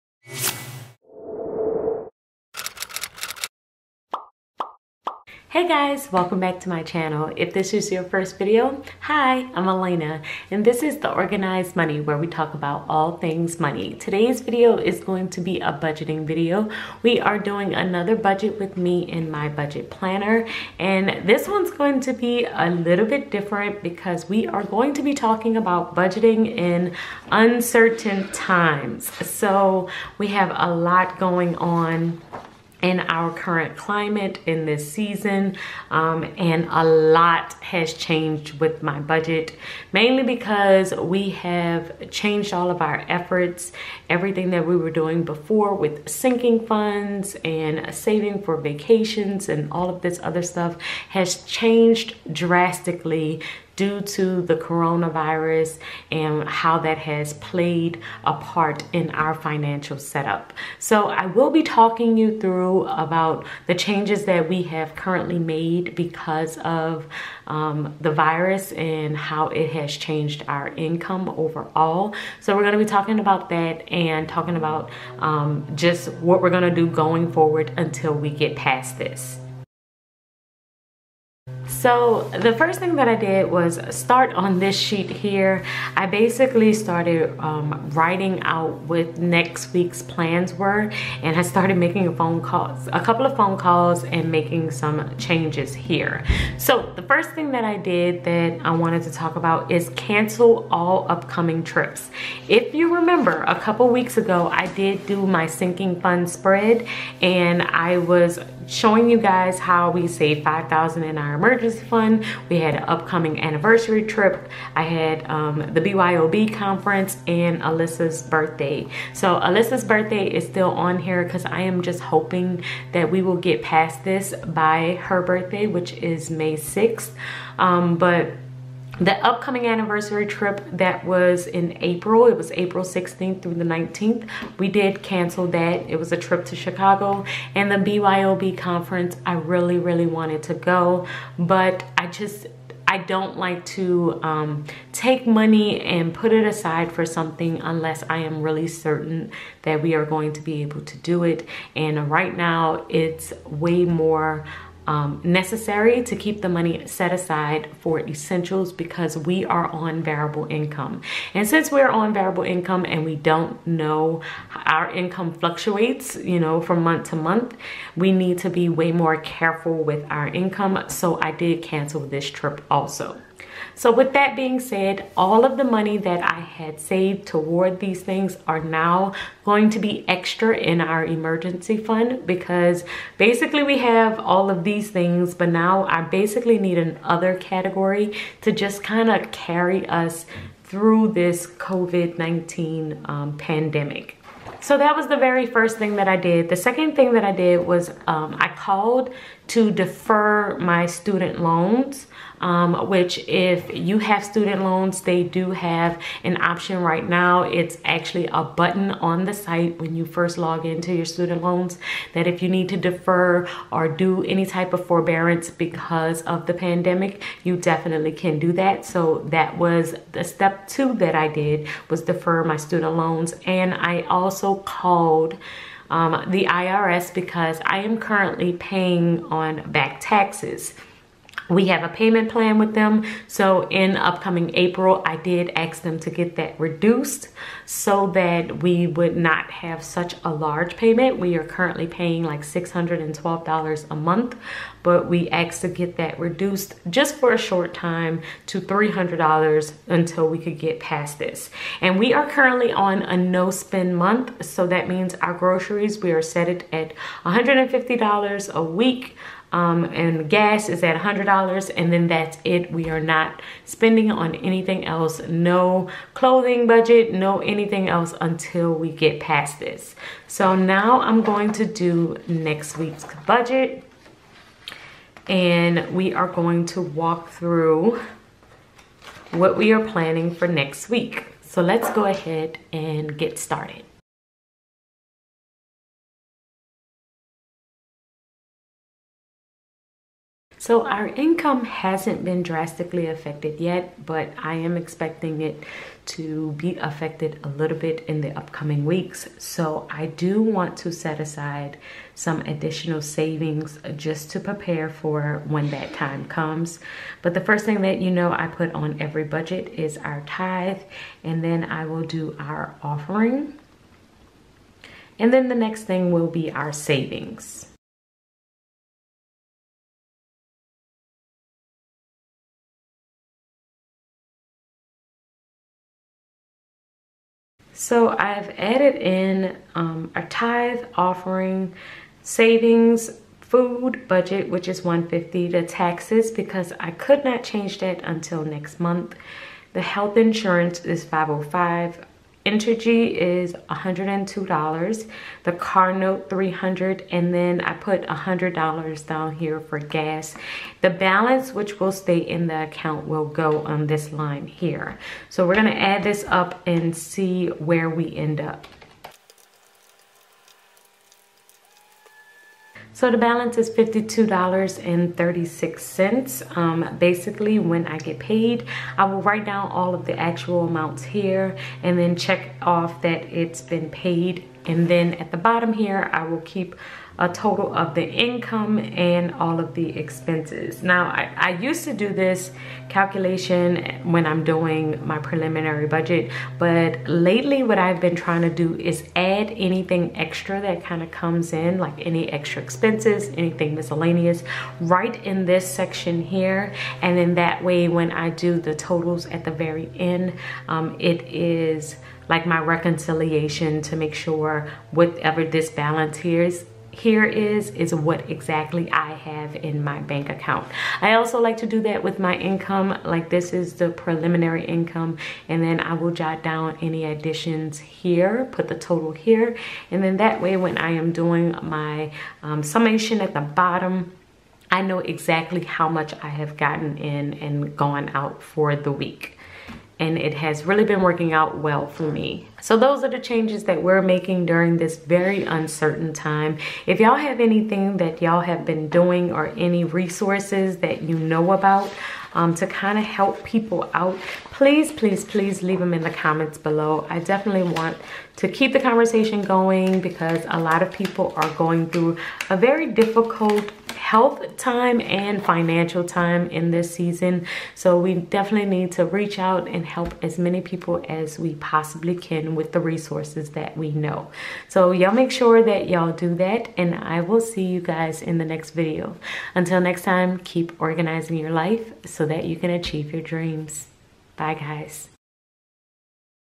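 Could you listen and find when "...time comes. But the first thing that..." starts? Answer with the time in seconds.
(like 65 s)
305 s.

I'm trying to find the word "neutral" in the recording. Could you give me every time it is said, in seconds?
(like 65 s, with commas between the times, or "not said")
not said.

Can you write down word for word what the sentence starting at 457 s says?
So we definitely need to reach out and help as many people as we possibly can with the resources that we know.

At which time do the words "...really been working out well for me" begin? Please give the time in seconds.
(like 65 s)
430 s.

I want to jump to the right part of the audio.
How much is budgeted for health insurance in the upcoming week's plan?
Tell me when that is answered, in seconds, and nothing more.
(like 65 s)
341 s.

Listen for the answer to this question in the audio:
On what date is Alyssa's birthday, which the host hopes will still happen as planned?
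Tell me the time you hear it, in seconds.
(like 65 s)
126 s.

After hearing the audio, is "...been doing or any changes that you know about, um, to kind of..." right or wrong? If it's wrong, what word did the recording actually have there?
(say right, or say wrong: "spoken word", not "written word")
wrong: "resources", not "changes".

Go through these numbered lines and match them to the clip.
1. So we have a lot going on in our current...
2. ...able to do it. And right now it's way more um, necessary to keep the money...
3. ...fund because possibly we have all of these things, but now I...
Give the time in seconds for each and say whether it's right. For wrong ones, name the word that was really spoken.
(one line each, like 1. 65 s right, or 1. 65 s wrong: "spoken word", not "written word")
1. 29 s right
2. 150 s right
3. 181 s wrong: "basically", not "possibly".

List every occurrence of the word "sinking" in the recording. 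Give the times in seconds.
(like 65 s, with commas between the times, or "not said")
46 s, 105 s.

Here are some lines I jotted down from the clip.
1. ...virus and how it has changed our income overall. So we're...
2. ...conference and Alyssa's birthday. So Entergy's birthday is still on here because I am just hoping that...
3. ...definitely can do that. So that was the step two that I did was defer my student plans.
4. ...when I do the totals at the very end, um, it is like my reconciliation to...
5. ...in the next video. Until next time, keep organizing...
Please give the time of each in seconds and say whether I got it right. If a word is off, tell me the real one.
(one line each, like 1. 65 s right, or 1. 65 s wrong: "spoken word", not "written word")
1. 68 s right
2. 116 s wrong: "Alyssa", not "Entergy"
3. 217 s wrong: "loans", not "plans"
4. 397 s right
5. 468 s right.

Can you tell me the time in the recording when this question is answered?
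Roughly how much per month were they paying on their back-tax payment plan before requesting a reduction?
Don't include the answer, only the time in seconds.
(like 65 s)
242 s.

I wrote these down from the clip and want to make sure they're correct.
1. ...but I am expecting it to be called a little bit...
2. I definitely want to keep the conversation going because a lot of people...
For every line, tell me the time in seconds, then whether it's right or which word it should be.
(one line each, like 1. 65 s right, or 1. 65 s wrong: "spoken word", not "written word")
1. 294 s wrong: "affected", not "called"
2. 447 s right.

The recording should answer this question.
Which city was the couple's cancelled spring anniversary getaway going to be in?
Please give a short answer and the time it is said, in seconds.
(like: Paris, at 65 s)
Chicago, at 136 s.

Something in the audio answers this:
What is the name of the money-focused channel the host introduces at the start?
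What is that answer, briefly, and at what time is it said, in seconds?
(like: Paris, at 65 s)
The Organized Money, at 10 s.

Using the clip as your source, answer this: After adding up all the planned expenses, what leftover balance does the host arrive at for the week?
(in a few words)
$52.36.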